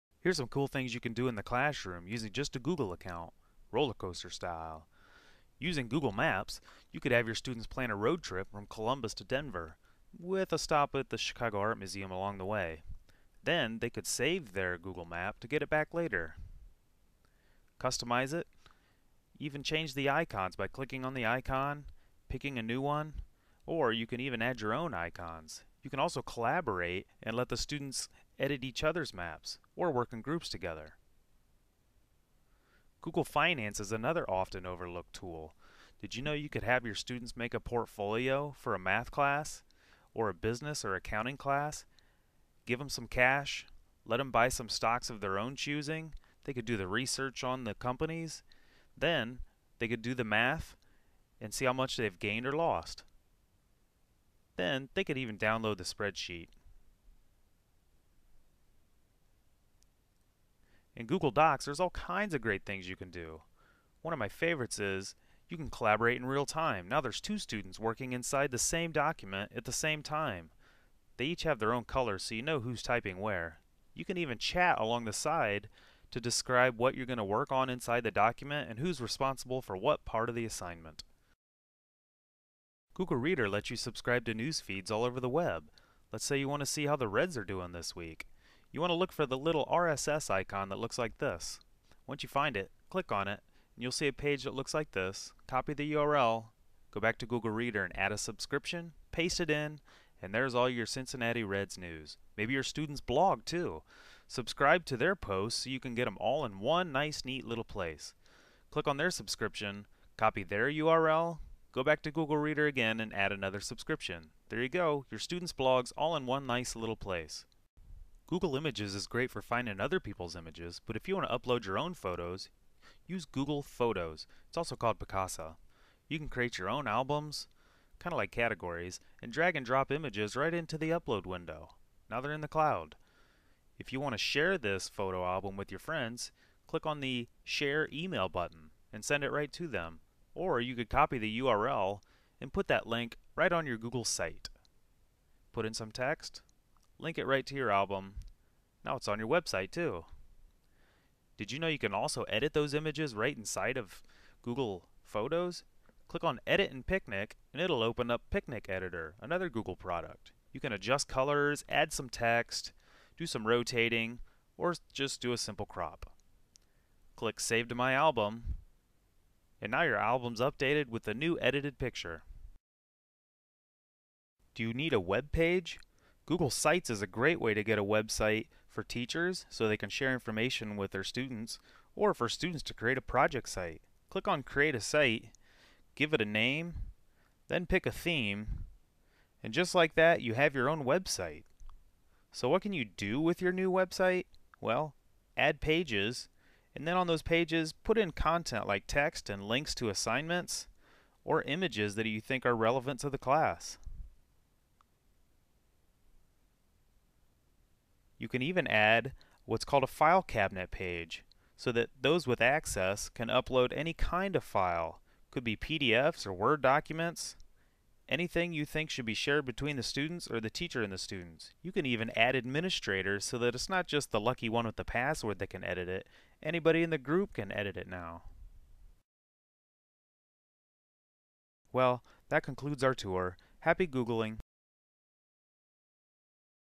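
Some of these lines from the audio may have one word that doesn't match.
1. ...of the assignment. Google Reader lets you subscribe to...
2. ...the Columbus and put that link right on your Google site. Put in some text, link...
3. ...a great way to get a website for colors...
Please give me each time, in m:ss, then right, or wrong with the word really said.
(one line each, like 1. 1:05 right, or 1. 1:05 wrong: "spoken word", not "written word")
1. 1:20 right
2. 2:21 wrong: "URL", not "Columbus"
3. 2:57 wrong: "teachers", not "colors".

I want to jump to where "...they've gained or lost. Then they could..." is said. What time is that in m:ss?
0:51.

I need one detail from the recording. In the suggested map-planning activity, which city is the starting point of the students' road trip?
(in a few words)
Columbus.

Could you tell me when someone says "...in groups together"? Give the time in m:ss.
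0:30.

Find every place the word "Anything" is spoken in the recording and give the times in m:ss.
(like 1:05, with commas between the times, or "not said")
3:38.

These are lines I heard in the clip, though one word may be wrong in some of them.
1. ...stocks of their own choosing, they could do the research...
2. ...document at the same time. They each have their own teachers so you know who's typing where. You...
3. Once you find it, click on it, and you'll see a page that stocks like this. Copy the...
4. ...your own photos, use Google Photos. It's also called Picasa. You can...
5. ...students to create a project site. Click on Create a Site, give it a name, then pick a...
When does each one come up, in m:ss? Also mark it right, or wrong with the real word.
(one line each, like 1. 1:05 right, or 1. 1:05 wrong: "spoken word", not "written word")
1. 0:44 right
2. 1:08 wrong: "colors", not "teachers"
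3. 1:32 wrong: "looks", not "stocks"
4. 2:01 right
5. 3:02 right.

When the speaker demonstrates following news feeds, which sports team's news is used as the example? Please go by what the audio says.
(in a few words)
Cincinnati Reds.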